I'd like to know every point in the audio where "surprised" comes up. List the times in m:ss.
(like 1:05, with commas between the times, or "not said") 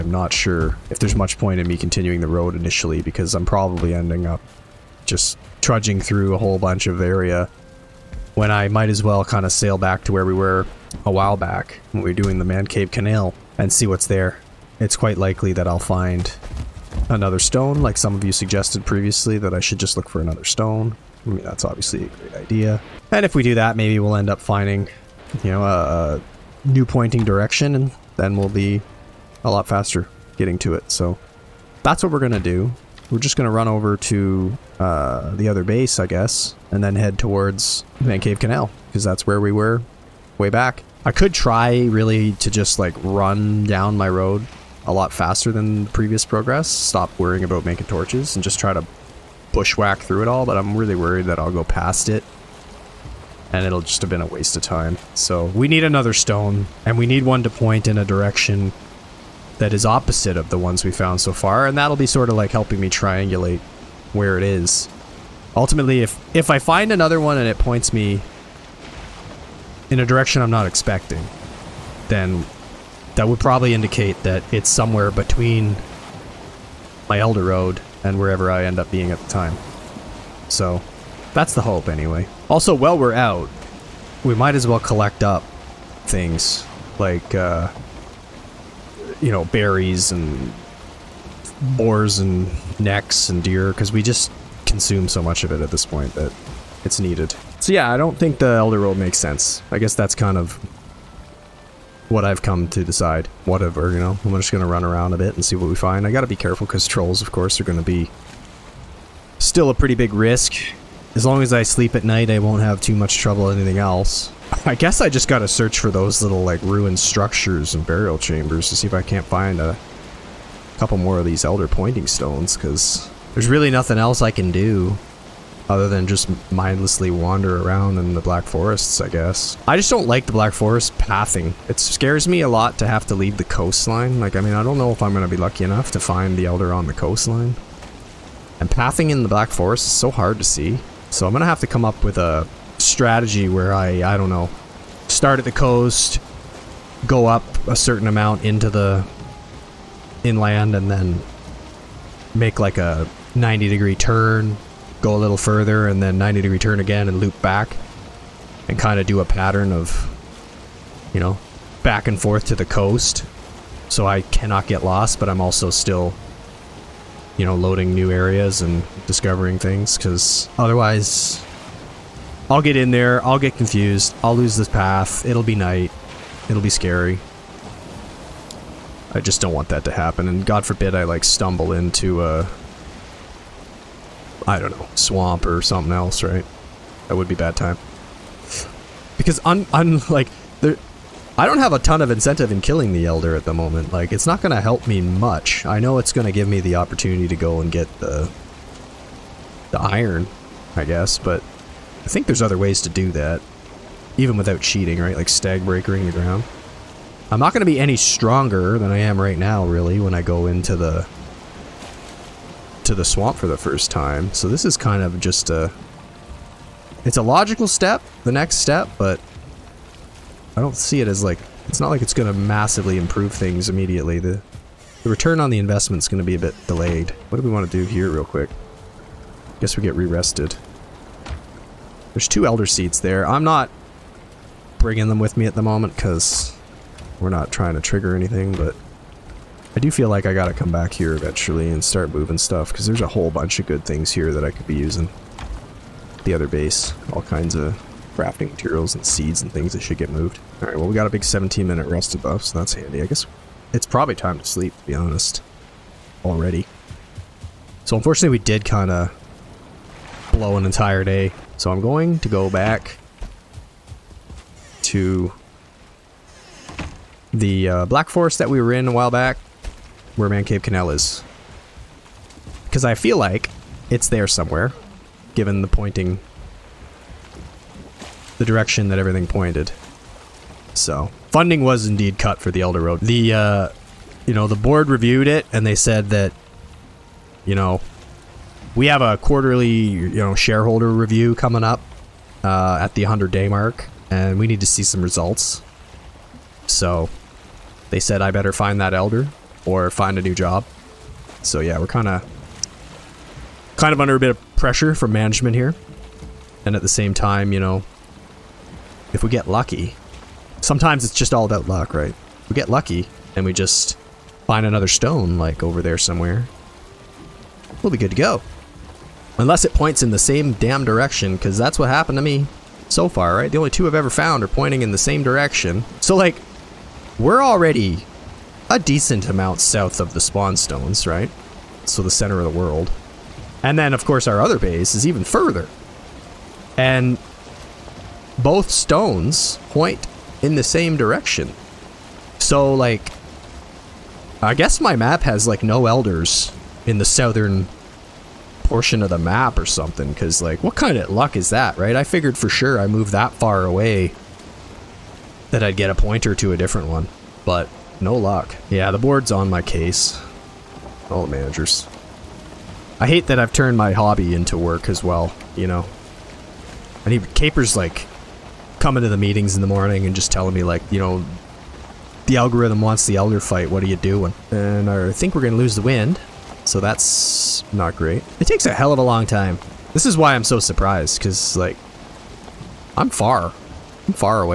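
6:20.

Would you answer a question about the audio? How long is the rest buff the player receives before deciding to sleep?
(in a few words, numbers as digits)
17 minute.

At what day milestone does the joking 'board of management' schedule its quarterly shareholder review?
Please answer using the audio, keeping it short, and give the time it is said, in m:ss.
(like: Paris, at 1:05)
100 day, at 4:53.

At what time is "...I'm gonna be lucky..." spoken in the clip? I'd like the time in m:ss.
2:15.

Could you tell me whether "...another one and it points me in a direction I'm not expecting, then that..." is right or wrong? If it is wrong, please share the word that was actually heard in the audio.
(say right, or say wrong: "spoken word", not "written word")
right.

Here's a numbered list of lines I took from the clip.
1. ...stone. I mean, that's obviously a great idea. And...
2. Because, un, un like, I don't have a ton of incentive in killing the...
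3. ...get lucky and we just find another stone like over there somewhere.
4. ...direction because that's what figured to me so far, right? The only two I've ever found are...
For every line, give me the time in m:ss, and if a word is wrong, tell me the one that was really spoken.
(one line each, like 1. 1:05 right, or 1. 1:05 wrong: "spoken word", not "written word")
1. 0:20 right
2. 3:09 right
3. 5:12 right
4. 5:20 wrong: "happened", not "figured".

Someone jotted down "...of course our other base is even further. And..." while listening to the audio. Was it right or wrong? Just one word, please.
right.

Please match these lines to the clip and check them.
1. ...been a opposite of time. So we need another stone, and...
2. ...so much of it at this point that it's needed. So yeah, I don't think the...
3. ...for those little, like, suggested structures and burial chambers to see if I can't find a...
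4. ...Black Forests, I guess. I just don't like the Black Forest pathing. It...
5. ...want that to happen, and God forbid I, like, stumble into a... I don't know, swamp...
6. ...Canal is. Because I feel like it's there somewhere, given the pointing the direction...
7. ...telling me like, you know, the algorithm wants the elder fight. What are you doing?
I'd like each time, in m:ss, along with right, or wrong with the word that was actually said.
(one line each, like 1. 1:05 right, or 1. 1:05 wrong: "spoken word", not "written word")
1. 0:54 wrong: "waste", not "opposite"
2. 1:35 right
3. 1:55 wrong: "ruined", not "suggested"
4. 2:08 right
5. 2:59 right
6. 4:30 right
7. 6:10 right.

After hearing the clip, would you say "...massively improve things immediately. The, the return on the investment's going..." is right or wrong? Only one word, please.
right.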